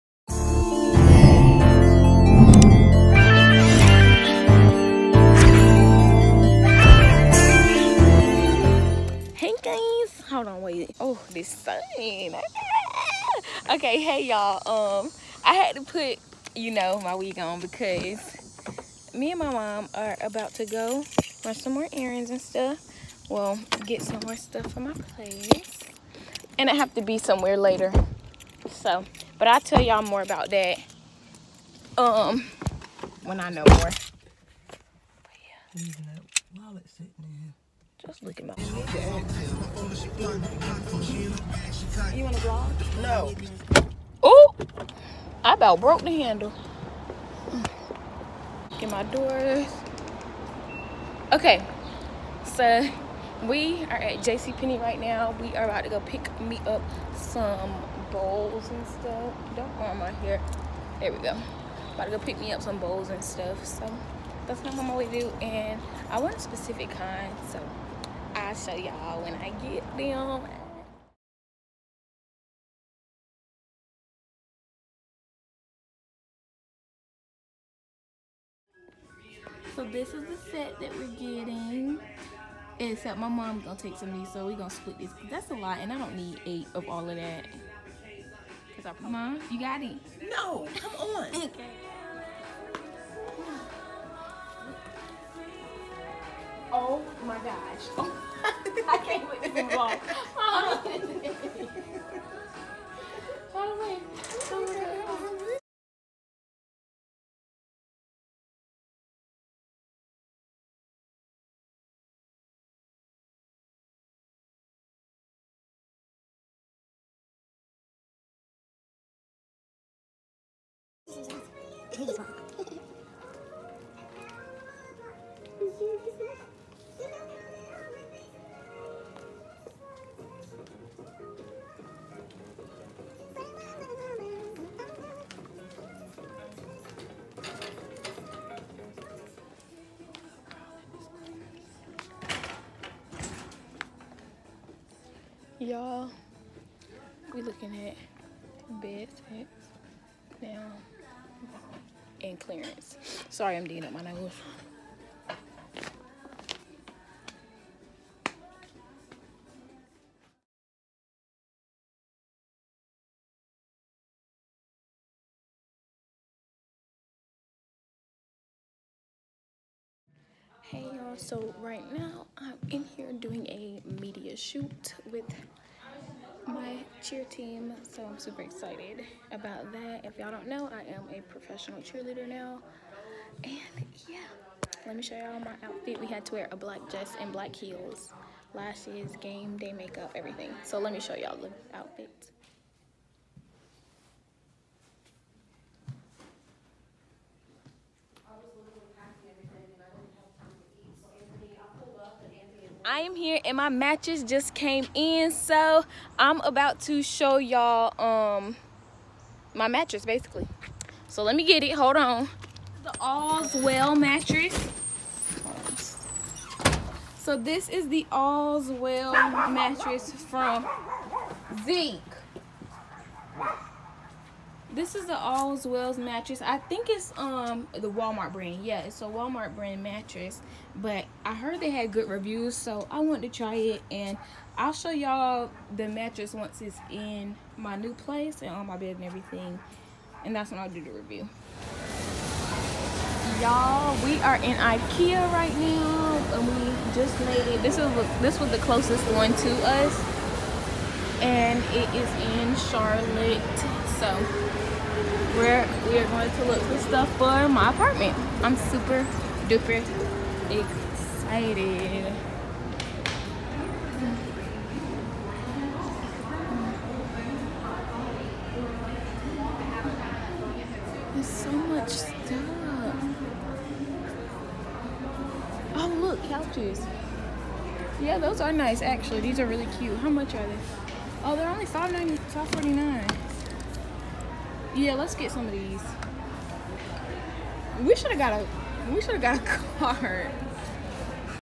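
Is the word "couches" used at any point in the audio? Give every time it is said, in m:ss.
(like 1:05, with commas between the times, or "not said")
4:36.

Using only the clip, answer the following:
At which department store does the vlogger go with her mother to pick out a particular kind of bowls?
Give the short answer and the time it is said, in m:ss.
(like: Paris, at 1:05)
JCPenney, at 0:54.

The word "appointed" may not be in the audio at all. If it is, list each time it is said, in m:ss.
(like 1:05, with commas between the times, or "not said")
not said.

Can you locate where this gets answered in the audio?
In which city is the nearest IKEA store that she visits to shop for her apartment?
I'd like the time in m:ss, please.
4:12.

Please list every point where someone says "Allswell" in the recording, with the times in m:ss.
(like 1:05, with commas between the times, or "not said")
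3:32, 3:38, 3:45.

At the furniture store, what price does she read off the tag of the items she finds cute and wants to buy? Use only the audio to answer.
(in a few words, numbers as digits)
$5.49.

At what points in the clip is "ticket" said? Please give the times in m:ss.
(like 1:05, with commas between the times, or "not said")
not said.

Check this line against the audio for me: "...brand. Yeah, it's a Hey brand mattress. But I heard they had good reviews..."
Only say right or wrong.
wrong.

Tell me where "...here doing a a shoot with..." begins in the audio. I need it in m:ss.
2:52.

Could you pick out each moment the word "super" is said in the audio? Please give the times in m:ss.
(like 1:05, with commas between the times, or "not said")
2:58, 4:18.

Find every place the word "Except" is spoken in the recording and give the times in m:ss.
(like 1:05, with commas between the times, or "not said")
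1:22.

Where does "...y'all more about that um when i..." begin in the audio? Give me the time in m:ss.
0:29.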